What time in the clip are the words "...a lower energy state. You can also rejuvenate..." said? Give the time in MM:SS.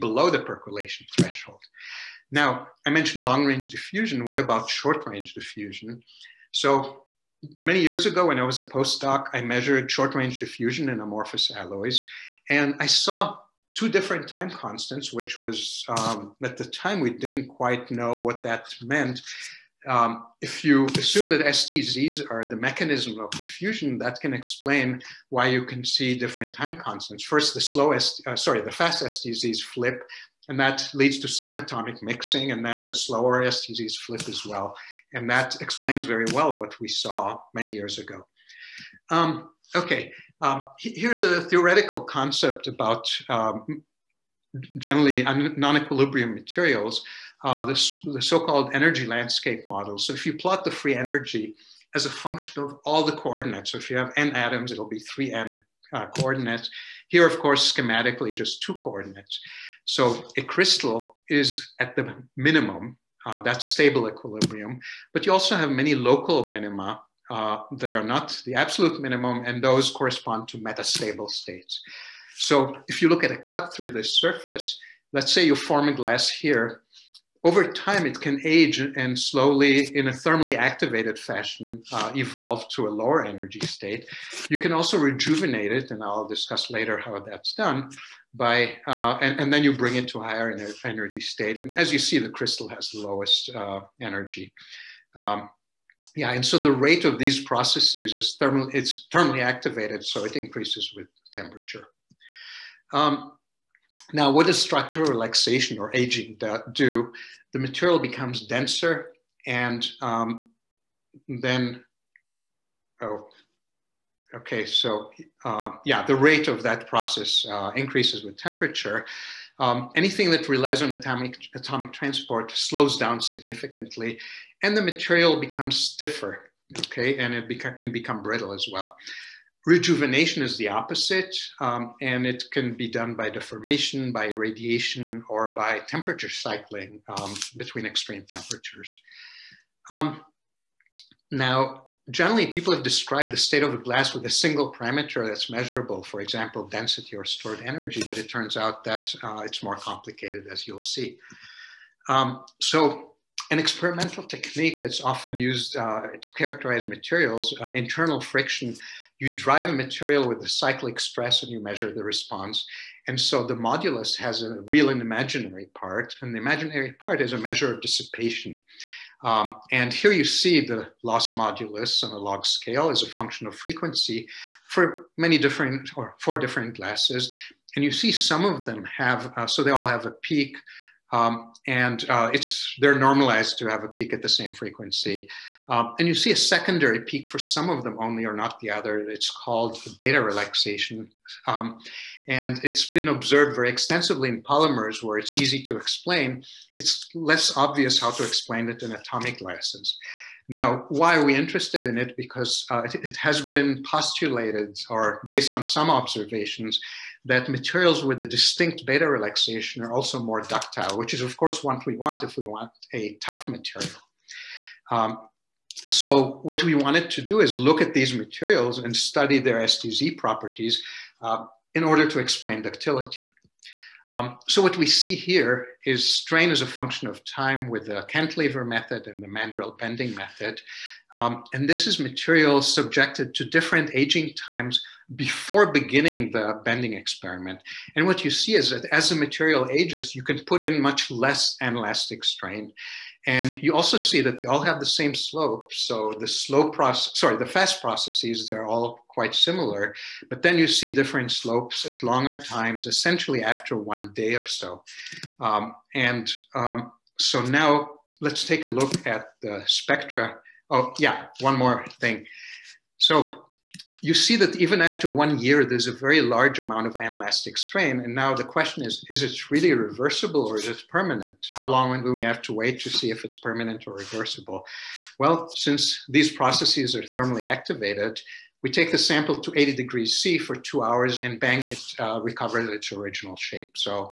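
01:22.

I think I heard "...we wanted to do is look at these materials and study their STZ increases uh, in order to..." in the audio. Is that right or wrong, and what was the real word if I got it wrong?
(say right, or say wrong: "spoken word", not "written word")
wrong: "properties", not "increases".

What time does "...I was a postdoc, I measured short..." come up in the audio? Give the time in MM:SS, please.
00:08.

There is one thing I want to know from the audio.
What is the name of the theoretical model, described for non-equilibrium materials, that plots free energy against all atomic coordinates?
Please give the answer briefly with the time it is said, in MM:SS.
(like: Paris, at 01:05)
energy landscape model, at 00:48.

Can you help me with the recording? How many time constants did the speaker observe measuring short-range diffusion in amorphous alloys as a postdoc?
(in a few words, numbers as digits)
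2.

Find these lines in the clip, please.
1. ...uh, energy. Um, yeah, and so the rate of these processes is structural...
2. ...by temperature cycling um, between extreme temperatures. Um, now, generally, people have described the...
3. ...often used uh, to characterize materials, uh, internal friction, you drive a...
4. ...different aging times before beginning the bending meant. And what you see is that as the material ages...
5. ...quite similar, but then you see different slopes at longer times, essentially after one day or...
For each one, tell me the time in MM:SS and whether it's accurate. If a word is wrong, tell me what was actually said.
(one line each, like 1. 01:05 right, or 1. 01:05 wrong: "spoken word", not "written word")
1. 01:33 wrong: "thermal", not "structural"
2. 02:15 right
3. 02:35 right
4. 03:53 wrong: "experiment", not "meant"
5. 04:09 right.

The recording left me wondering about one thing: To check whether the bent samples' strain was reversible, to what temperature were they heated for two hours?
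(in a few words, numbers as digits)
80 degrees C.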